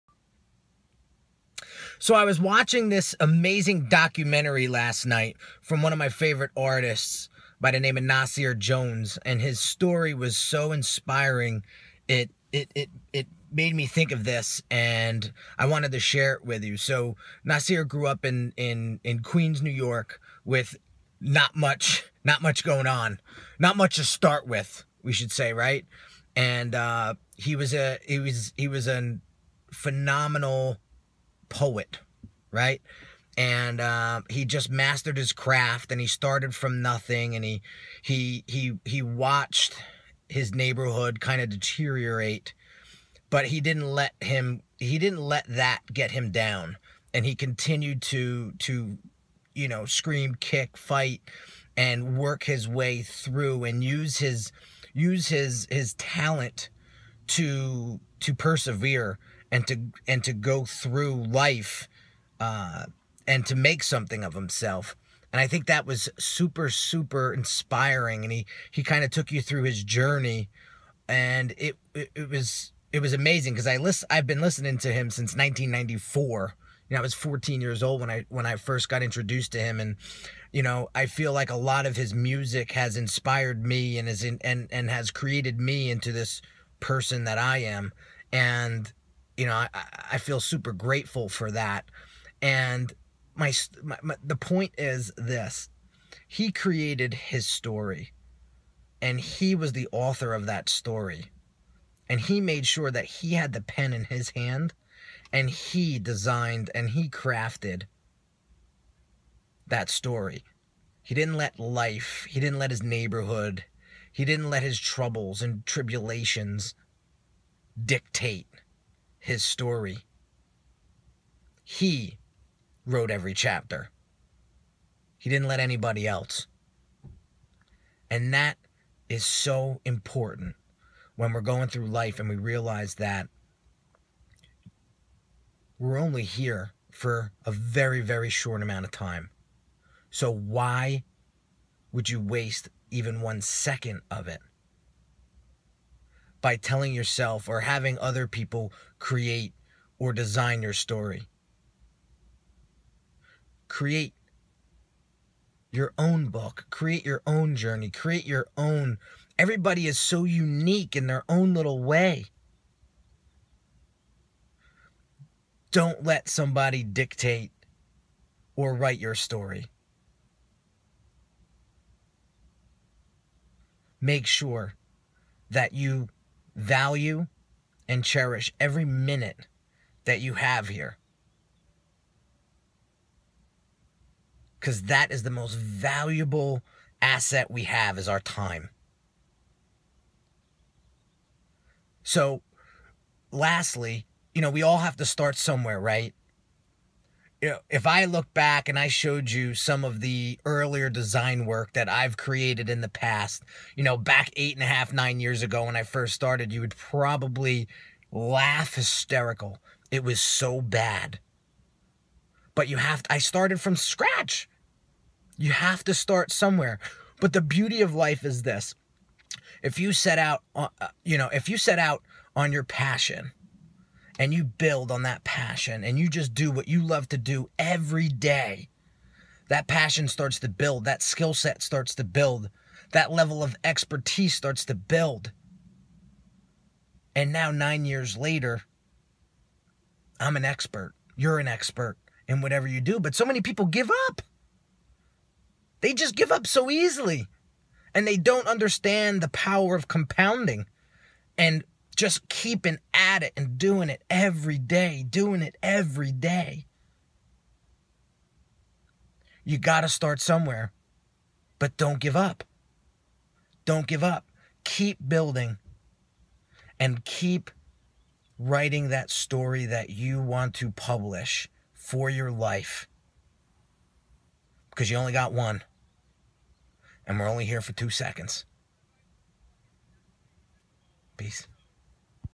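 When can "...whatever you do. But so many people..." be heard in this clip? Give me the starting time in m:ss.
4:02.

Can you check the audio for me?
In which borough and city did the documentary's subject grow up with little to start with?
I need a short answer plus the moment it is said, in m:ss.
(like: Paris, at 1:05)
Queens, New York, at 0:19.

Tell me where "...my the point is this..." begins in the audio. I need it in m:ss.
1:34.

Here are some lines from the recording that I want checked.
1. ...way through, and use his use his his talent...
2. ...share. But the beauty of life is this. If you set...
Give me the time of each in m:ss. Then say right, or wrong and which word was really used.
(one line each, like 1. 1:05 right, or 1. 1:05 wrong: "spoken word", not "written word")
1. 0:52 right
2. 3:36 wrong: "somewhere", not "share".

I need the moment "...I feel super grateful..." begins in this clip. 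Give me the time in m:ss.
1:30.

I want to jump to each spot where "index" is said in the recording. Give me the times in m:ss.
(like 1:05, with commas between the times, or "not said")
not said.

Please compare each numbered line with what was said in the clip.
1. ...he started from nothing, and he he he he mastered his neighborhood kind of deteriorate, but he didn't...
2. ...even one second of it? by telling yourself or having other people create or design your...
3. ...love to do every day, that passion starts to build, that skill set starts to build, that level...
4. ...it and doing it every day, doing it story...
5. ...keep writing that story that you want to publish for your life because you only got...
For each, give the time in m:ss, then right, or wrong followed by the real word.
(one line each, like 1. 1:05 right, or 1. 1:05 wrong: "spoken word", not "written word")
1. 0:36 wrong: "watched", not "mastered"
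2. 2:22 right
3. 3:46 right
4. 4:13 wrong: "every", not "story"
5. 4:27 right.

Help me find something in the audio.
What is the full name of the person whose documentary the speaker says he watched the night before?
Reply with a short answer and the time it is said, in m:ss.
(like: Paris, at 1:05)
Nasir Jones, at 0:08.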